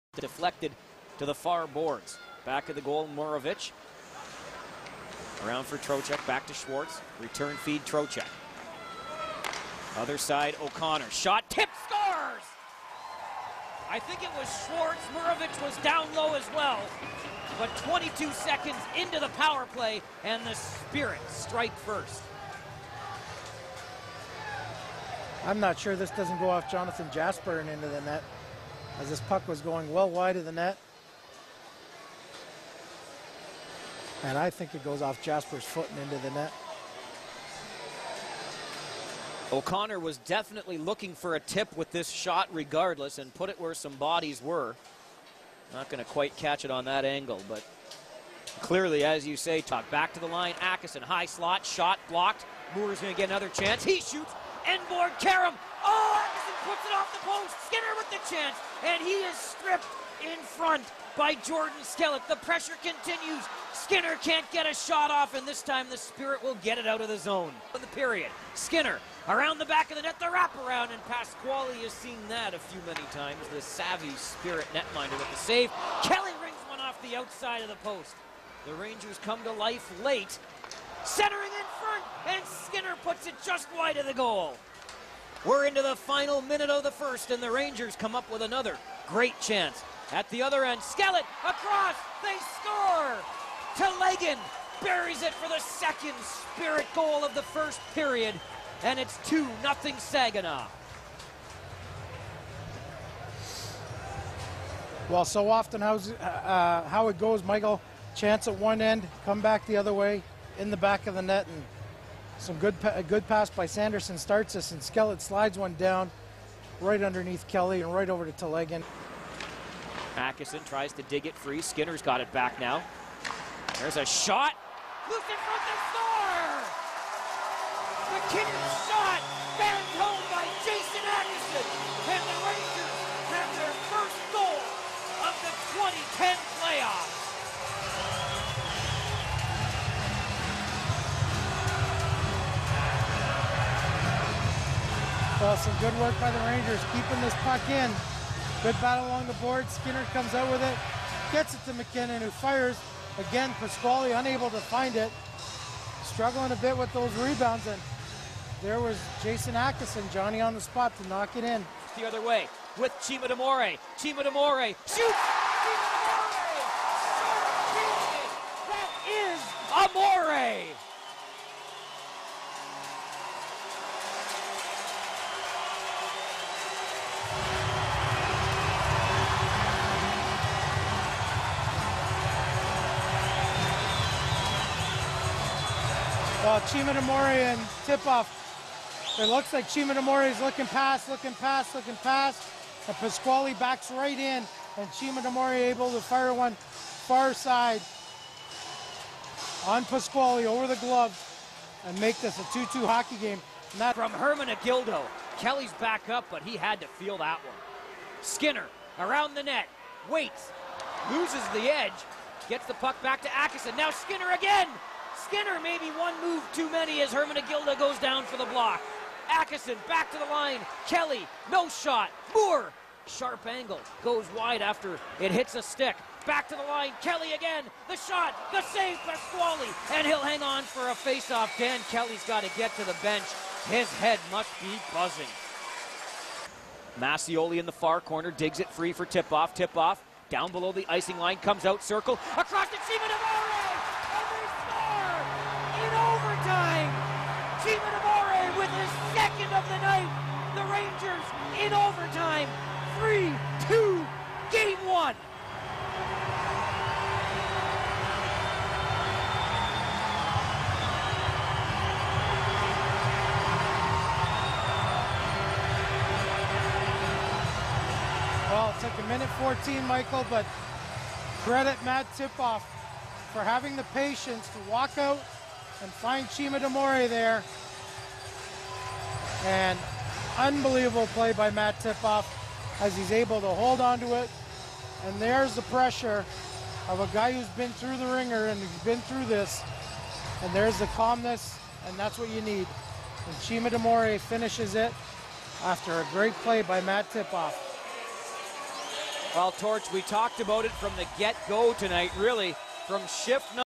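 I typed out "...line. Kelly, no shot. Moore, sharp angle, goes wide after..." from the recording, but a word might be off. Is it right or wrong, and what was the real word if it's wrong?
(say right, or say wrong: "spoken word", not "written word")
right.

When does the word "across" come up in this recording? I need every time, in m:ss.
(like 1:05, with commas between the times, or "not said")
1:31, 4:02.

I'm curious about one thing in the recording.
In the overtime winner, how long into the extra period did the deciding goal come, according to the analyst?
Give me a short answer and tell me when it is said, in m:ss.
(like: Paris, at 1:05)
1 minute 14 seconds, at 4:28.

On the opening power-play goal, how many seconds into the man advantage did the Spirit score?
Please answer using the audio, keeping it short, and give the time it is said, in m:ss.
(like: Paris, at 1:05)
22, at 0:17.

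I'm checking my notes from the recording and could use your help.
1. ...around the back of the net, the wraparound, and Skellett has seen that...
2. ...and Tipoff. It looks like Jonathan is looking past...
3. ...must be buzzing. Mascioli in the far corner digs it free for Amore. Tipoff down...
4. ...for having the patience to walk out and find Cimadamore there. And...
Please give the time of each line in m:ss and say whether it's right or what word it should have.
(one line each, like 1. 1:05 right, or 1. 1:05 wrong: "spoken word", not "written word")
1. 1:09 wrong: "Pasquale", not "Skellett"
2. 3:07 wrong: "Cimadamore", not "Jonathan"
3. 3:54 wrong: "Tipoff", not "Amore"
4. 4:33 right.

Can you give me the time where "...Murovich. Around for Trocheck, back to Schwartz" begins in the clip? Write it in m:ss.
0:03.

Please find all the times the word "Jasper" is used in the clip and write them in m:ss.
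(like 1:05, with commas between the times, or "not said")
0:27, 0:35.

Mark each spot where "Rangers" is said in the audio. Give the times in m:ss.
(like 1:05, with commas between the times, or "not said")
1:18, 1:27, 2:26, 4:10.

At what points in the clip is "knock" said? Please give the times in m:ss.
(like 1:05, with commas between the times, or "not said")
2:41.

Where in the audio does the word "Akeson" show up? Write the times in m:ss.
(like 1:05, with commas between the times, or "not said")
0:50, 2:11, 2:39, 3:33, 3:39.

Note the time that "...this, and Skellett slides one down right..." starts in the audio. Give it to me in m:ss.
1:54.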